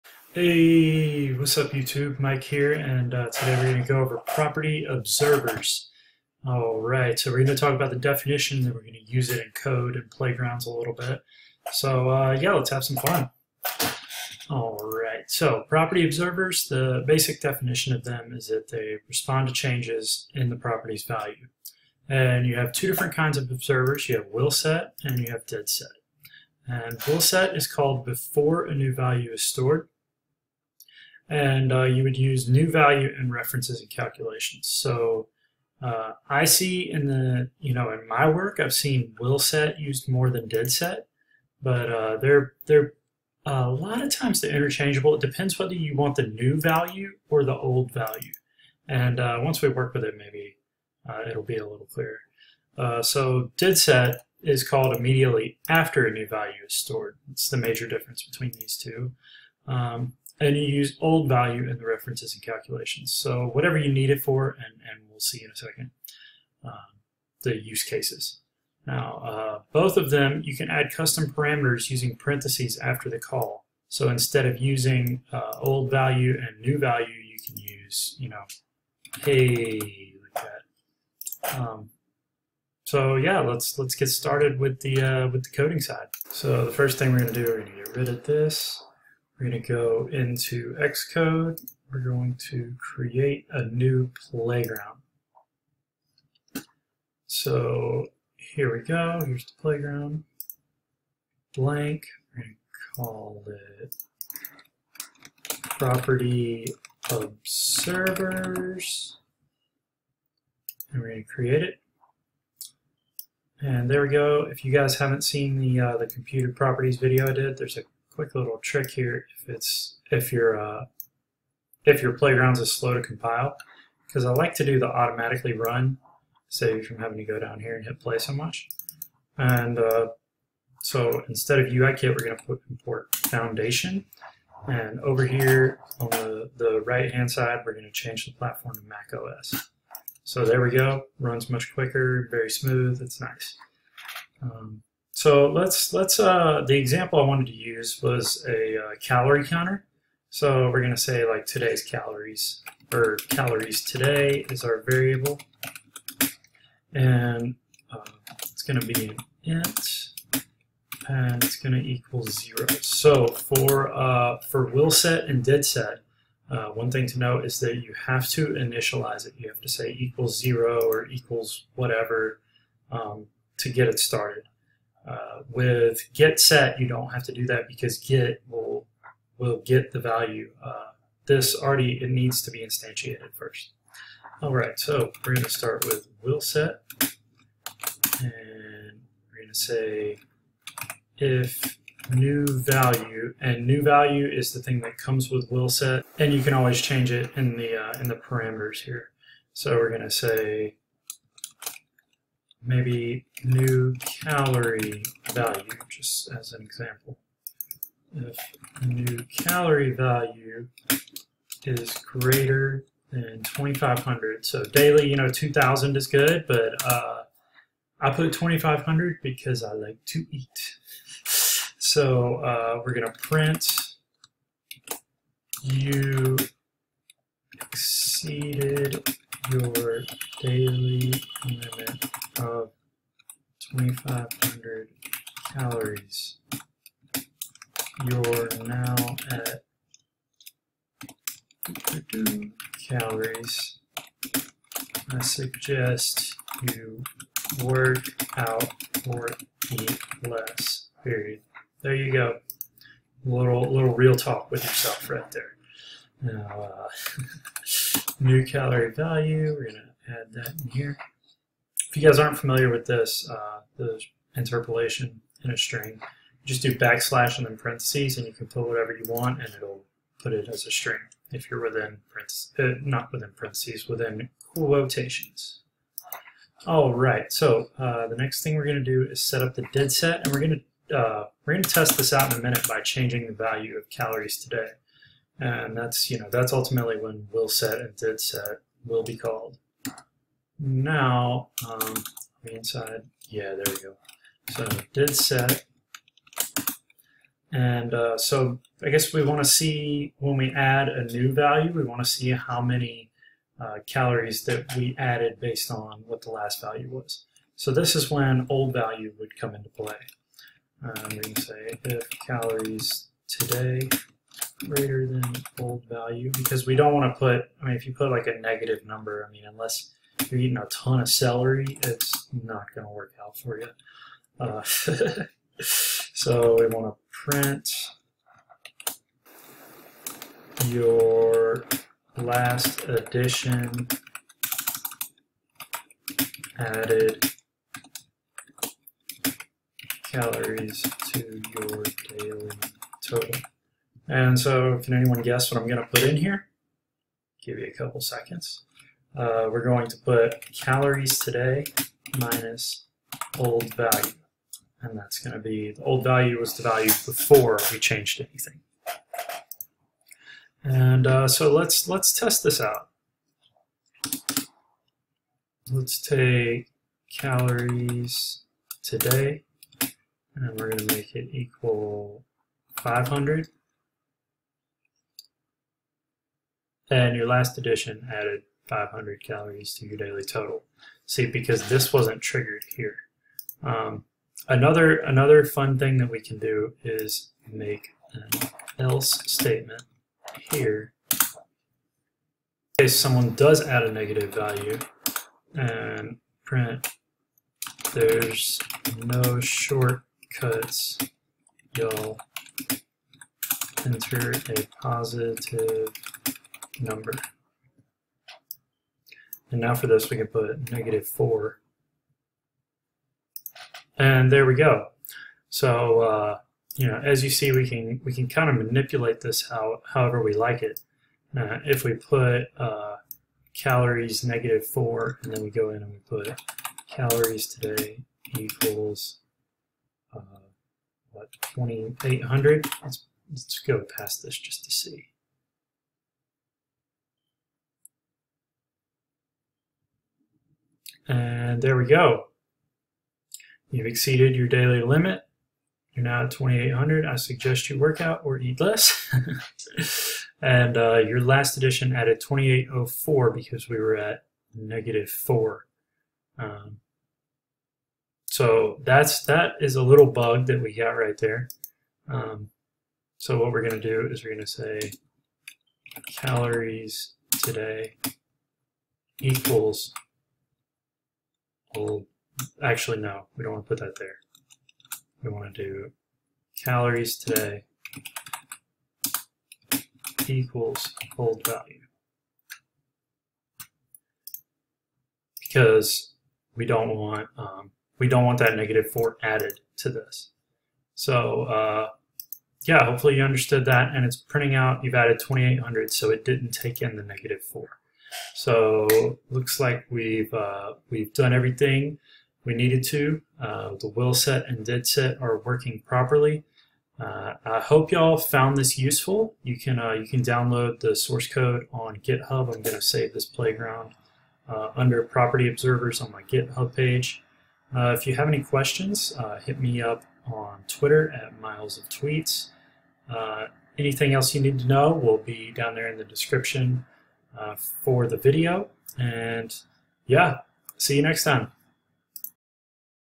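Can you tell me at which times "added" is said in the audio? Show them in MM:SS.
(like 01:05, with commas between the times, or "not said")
05:04, 05:36, 06:18, 07:31, 08:09, 08:14.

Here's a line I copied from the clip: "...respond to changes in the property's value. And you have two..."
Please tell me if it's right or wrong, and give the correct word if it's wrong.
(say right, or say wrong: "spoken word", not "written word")
right.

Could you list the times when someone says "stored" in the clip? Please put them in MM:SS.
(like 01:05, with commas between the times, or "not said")
00:29, 00:56.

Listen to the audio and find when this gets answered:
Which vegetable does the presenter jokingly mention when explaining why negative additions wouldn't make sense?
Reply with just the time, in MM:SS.
05:21.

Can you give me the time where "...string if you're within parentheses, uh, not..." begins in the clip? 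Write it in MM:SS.
04:30.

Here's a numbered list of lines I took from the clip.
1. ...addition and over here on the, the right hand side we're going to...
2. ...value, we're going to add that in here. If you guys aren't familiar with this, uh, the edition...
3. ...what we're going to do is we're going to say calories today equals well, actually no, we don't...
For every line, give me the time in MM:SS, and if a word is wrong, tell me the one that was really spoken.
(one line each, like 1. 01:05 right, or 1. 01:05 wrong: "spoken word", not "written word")
1. 02:13 wrong: "foundation", not "addition"
2. 04:18 wrong: "interpolation", not "edition"
3. 07:43 right.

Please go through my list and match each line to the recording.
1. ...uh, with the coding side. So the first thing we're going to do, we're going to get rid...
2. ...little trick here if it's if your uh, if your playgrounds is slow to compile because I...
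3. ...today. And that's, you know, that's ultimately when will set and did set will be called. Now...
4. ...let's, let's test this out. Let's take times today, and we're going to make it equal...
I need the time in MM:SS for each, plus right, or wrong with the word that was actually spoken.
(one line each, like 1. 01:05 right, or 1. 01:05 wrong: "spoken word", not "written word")
1. 01:25 right
2. 01:58 right
3. 04:44 right
4. 06:01 wrong: "calories", not "times".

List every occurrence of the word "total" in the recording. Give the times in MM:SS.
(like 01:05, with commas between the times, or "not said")
05:43, 06:20.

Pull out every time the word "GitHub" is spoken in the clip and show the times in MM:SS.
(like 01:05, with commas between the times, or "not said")
08:31, 08:36.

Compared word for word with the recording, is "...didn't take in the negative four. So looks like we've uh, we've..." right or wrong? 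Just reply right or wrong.
right.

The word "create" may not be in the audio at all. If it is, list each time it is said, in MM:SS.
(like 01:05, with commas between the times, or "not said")
01:32, 01:51.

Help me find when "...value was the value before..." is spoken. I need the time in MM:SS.
05:56.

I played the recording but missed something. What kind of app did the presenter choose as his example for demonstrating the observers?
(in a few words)
Calorie counter.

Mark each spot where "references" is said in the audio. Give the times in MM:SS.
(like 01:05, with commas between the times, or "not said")
00:33, 01:01.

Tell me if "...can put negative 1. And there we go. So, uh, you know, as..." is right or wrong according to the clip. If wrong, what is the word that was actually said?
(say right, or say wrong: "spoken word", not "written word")
wrong: "4", not "1".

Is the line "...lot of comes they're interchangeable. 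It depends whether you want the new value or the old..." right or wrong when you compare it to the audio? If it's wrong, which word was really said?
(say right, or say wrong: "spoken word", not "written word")
wrong: "times", not "comes".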